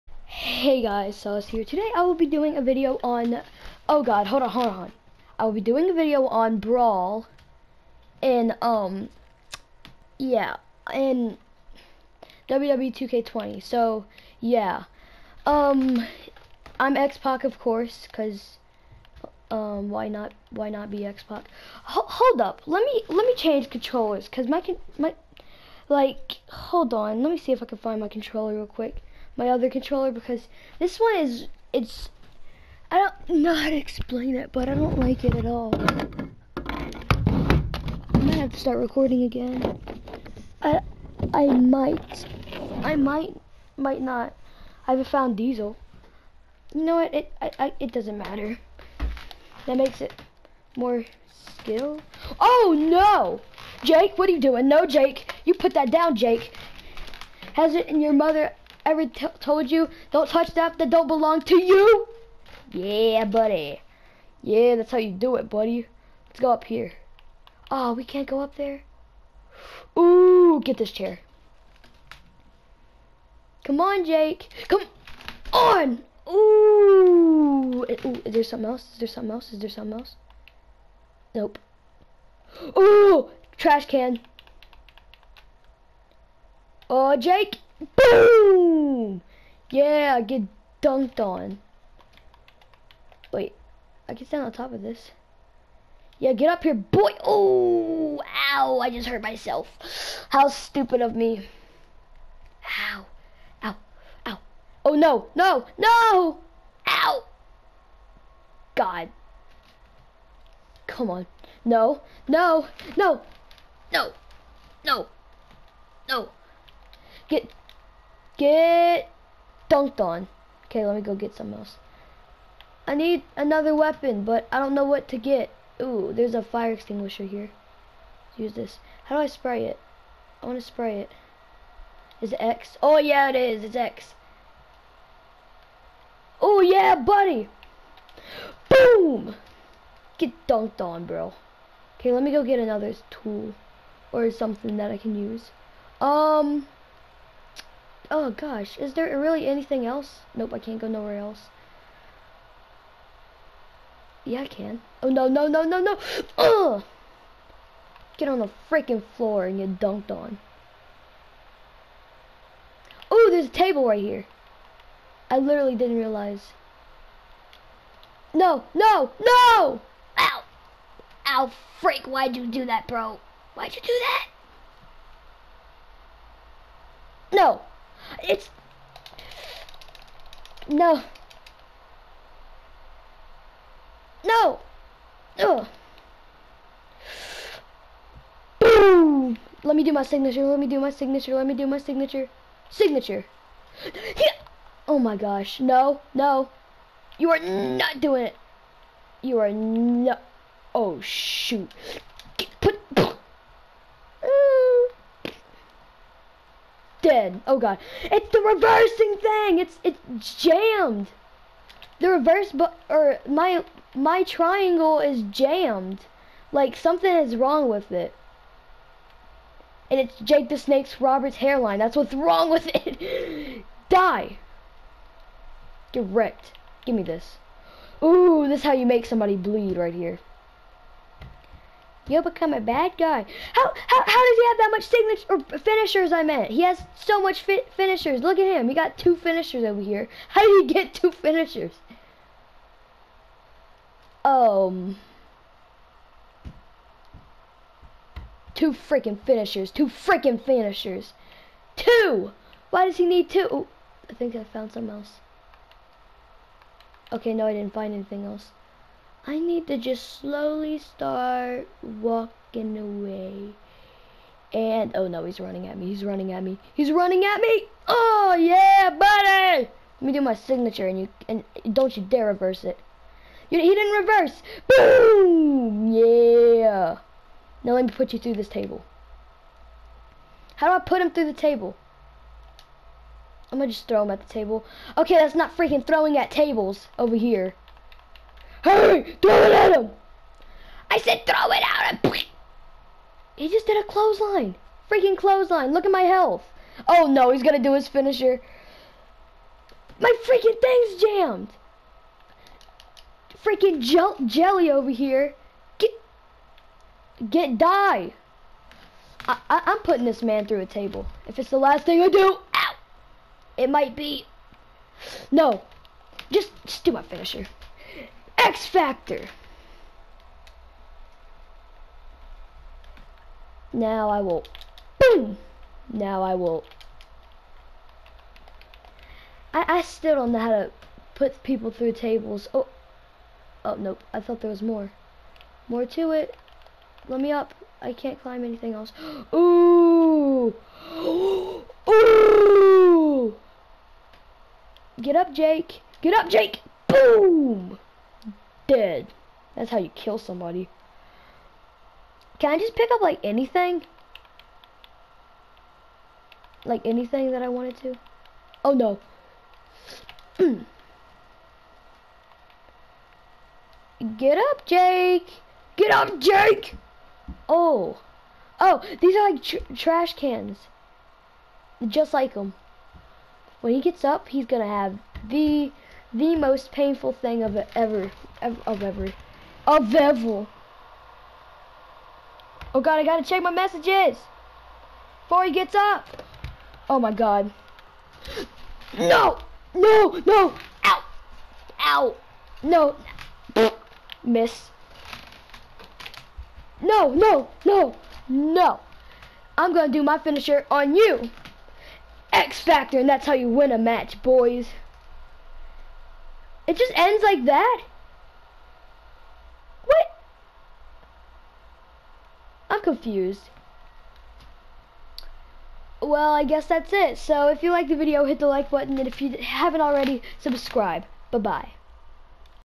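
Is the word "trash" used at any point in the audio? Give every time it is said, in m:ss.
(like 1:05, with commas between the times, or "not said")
1:23, 6:09.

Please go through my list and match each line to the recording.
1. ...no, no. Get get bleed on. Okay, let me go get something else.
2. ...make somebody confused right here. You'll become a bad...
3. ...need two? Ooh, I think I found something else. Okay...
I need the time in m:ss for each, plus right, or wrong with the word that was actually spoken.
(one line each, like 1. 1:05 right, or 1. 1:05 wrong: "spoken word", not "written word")
1. 1:54 wrong: "dunked", not "bleed"
2. 3:48 wrong: "bleed", not "confused"
3. 4:13 right.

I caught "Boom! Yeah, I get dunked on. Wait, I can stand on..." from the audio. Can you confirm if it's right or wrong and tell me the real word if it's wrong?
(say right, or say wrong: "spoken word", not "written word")
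right.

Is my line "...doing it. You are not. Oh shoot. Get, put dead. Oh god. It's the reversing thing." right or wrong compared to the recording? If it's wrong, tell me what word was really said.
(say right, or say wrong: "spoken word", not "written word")
right.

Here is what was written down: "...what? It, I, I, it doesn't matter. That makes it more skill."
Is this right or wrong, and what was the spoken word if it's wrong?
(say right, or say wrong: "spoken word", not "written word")
right.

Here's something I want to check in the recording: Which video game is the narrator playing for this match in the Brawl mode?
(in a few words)
WWE 2K20.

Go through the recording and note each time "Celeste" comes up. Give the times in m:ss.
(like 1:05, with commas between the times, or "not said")
0:01.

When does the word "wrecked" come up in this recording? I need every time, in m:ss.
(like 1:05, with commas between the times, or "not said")
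3:46.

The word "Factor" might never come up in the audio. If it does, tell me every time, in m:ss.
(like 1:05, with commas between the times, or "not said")
5:18, 6:42.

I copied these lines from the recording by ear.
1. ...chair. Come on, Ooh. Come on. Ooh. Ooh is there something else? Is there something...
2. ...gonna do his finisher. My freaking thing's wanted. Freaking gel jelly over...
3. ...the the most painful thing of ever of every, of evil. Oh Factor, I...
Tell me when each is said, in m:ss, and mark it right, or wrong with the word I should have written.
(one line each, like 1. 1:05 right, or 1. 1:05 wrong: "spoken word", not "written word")
1. 1:10 wrong: "Jake", not "Ooh"
2. 4:57 wrong: "jammed", not "wanted"
3. 6:15 wrong: "God", not "Factor".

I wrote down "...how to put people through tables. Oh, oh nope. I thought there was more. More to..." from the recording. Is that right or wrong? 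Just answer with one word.
right.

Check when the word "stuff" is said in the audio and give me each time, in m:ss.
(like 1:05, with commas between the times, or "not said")
1:00.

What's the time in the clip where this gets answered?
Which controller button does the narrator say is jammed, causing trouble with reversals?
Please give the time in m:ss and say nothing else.
3:34.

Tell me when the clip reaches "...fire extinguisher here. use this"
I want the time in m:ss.
2:06.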